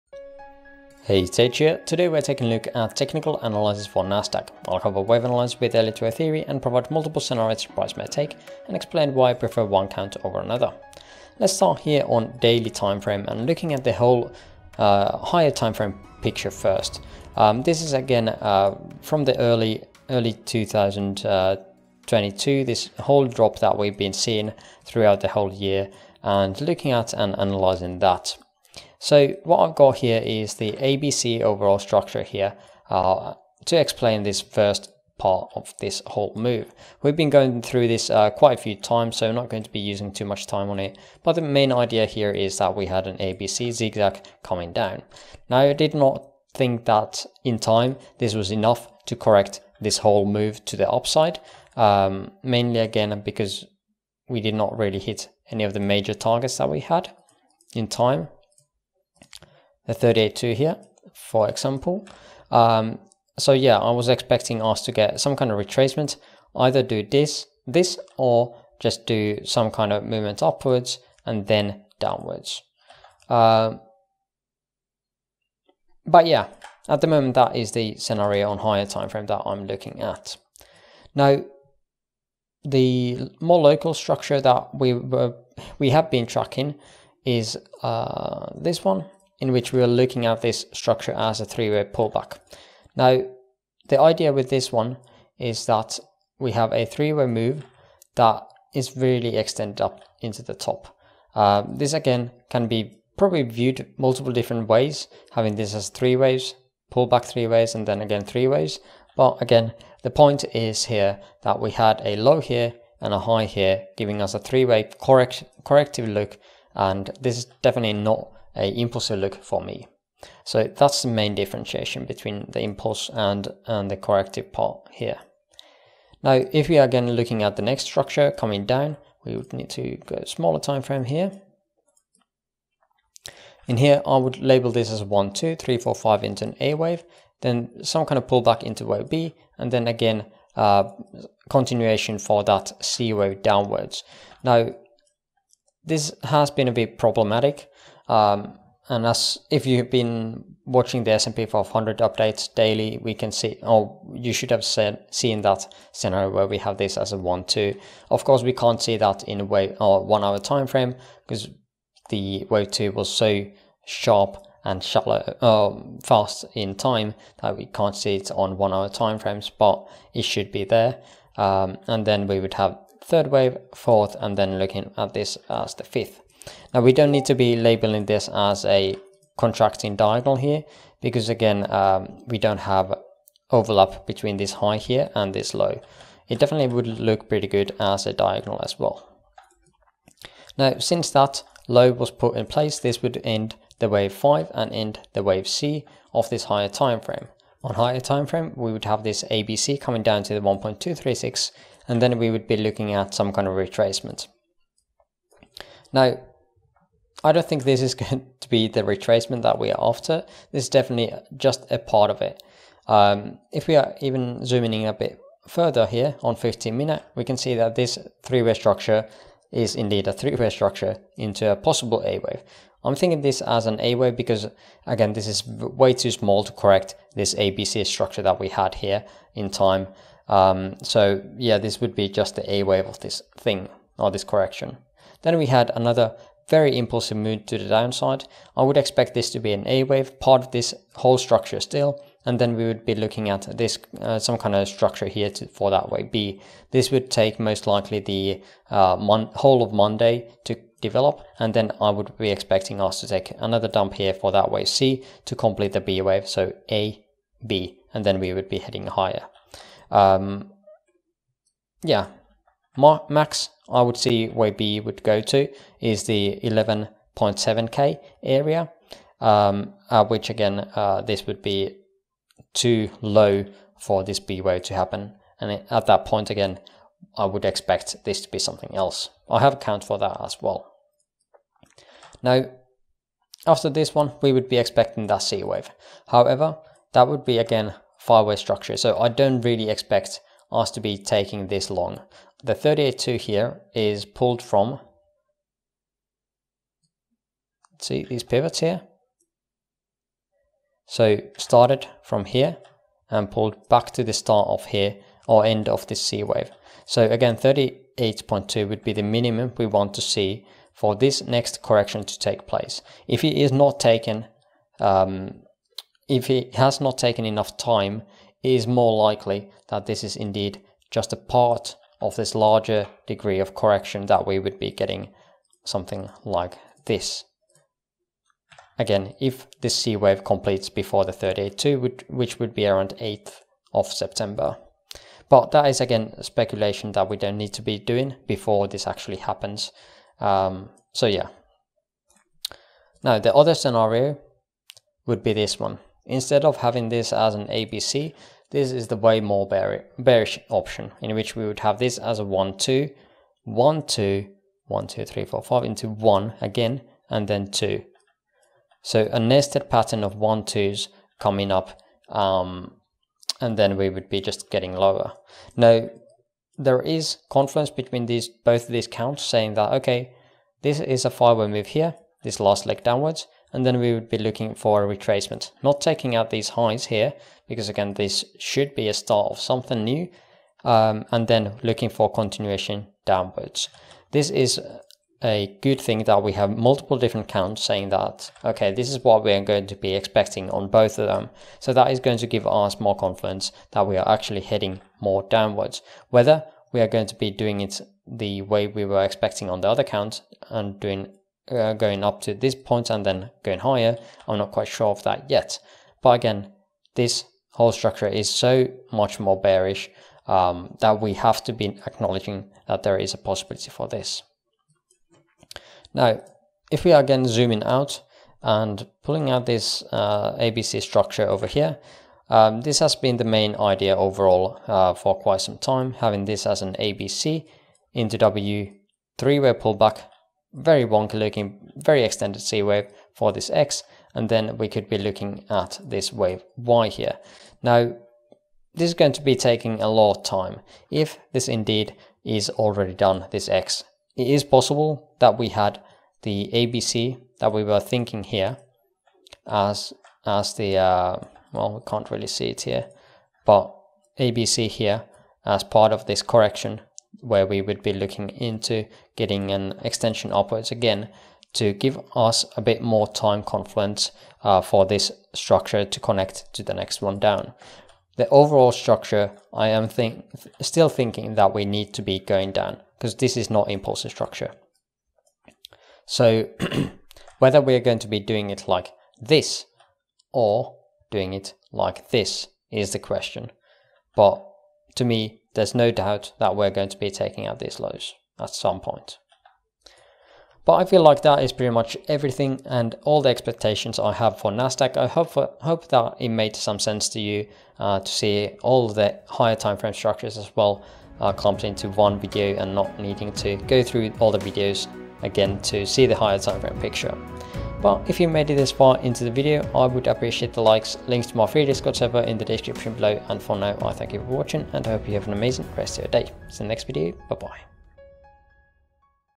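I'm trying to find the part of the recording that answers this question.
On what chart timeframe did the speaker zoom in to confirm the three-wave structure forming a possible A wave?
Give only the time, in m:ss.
3:36.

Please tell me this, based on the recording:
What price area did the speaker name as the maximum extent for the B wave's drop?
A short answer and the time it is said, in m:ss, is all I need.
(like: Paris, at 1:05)
11.7k, at 4:26.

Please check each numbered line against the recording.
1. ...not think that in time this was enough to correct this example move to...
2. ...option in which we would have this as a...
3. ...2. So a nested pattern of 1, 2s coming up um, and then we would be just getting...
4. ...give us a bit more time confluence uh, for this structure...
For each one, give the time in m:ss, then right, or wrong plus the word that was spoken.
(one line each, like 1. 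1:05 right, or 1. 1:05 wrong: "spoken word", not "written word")
1. 0:45 wrong: "whole", not "example"
2. 5:50 right
3. 5:57 right
4. 7:41 right.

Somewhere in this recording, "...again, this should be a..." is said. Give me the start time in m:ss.
6:17.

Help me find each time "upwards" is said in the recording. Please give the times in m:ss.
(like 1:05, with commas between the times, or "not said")
1:10, 7:40.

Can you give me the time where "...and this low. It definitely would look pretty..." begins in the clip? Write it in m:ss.
3:05.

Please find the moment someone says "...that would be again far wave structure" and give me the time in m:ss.
4:46.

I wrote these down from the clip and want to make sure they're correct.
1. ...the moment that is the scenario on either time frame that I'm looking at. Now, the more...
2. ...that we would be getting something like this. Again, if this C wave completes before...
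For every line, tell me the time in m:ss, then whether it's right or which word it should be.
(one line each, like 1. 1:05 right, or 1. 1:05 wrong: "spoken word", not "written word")
1. 1:17 wrong: "higher", not "either"
2. 5:24 right.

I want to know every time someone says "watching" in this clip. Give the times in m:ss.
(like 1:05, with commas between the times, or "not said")
2:30, 8:34.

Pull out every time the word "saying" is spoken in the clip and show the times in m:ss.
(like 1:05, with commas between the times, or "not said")
6:09, 6:27.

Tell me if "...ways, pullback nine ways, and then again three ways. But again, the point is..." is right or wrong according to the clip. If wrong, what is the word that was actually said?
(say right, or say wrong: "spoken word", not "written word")
wrong: "three", not "nine".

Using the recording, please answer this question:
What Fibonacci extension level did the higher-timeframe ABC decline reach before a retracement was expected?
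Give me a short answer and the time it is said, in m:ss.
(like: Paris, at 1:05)
1.236, at 3:20.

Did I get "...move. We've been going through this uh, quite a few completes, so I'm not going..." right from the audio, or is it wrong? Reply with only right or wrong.
wrong.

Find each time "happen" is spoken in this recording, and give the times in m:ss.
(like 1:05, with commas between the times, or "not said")
4:34, 5:39.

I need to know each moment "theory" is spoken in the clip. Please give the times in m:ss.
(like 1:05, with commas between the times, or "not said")
0:06.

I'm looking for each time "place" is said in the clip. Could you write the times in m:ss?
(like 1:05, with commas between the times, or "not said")
3:12, 5:12.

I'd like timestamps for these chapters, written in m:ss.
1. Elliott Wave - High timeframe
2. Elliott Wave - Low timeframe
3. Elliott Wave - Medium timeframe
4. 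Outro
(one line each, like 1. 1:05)
1. 0:15
2. 1:22
3. 6:58
4. 8:27.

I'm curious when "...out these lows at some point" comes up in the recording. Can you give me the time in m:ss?
8:07.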